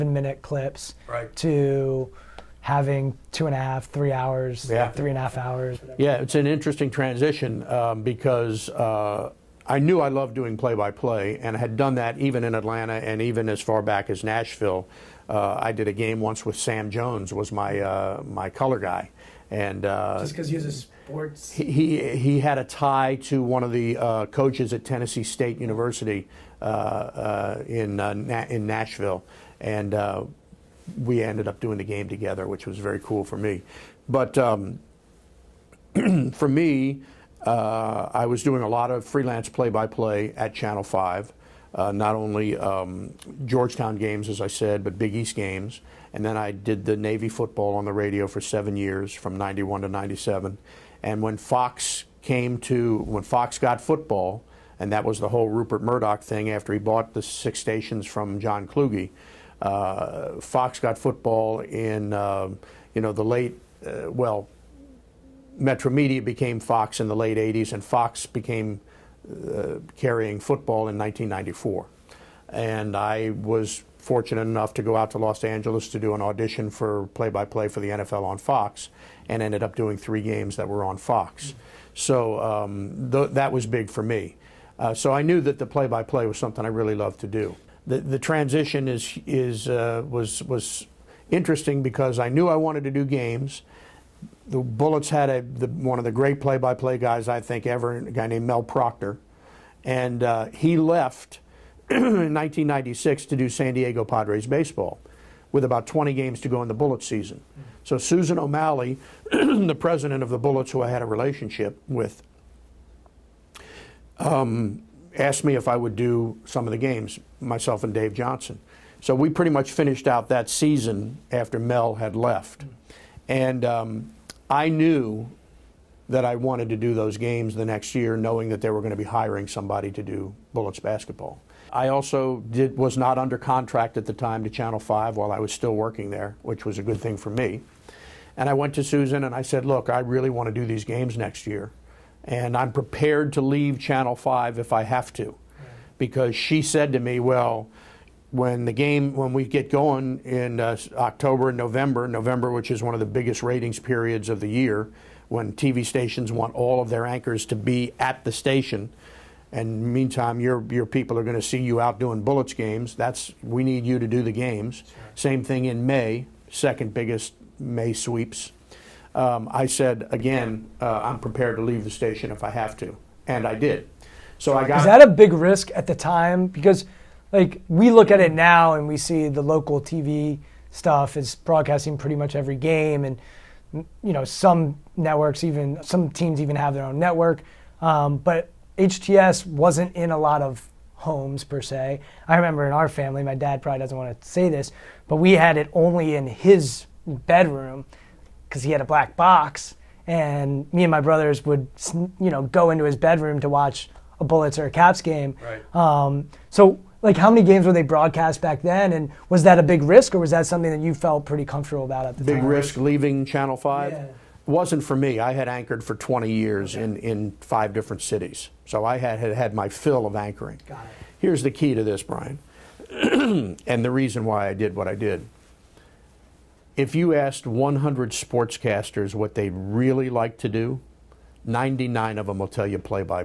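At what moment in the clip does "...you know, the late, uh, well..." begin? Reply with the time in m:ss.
1:02.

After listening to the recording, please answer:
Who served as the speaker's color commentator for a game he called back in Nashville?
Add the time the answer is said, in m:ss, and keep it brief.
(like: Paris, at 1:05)
Sam Jones, at 0:16.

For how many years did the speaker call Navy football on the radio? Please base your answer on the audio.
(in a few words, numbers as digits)
7.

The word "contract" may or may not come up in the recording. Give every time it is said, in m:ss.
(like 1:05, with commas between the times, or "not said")
2:13.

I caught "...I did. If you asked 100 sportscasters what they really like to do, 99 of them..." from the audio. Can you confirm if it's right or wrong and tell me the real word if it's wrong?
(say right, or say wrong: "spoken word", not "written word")
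right.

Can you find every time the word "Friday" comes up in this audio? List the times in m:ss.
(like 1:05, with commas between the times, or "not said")
not said.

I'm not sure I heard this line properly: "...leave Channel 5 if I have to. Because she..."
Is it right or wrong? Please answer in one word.
right.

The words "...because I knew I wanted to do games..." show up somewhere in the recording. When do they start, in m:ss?
1:31.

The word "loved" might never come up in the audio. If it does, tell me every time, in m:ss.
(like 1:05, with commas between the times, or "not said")
0:10, 1:26.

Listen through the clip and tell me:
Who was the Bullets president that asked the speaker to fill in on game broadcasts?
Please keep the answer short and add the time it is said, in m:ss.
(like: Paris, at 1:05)
Susan O'Malley, at 1:47.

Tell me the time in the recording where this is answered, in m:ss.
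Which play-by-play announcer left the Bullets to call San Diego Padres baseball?
1:38.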